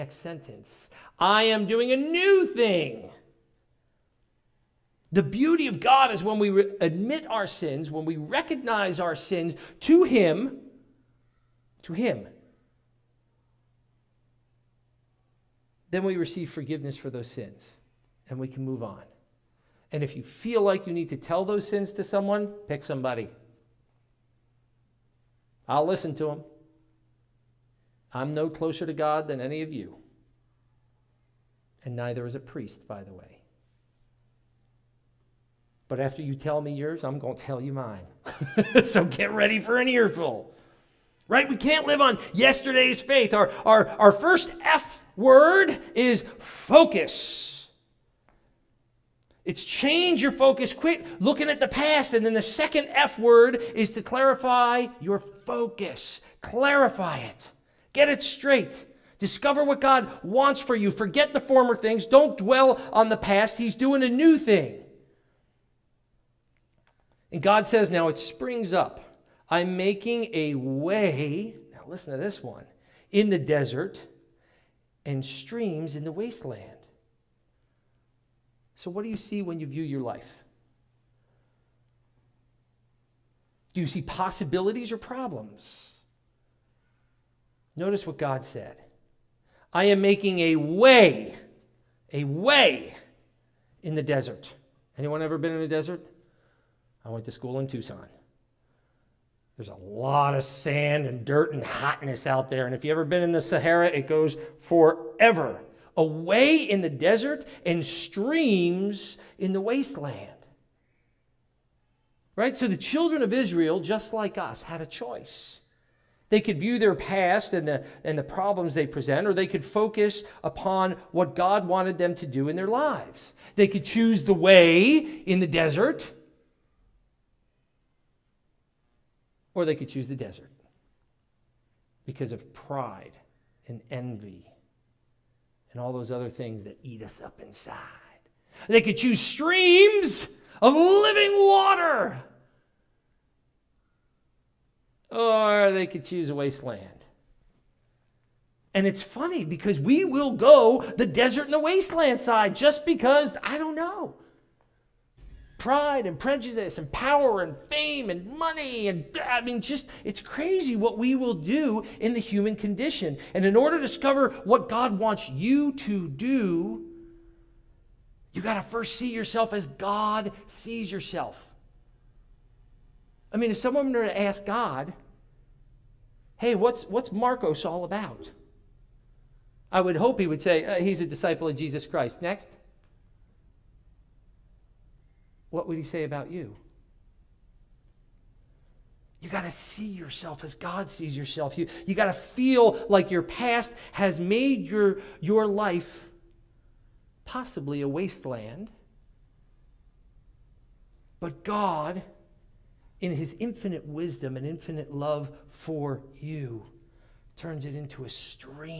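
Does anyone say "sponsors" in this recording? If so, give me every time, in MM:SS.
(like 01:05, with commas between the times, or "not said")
not said.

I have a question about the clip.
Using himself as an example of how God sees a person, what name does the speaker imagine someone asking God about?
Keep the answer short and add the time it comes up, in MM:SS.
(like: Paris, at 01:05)
Marcos, at 02:57.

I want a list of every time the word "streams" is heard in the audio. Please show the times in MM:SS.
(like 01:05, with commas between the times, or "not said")
01:15, 01:47, 02:19, 03:28.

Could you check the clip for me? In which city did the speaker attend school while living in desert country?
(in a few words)
Tucson.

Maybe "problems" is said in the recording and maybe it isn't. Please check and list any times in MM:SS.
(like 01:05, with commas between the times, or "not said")
01:24, 01:58.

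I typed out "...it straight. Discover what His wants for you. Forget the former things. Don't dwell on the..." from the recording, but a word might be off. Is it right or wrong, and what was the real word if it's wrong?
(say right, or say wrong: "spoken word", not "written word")
wrong: "God", not "His".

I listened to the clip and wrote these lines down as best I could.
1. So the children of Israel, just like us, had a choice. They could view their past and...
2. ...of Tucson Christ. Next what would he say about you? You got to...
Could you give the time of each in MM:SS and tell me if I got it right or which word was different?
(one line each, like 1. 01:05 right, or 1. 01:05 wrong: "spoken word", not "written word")
1. 01:52 right
2. 03:01 wrong: "Jesus", not "Tucson".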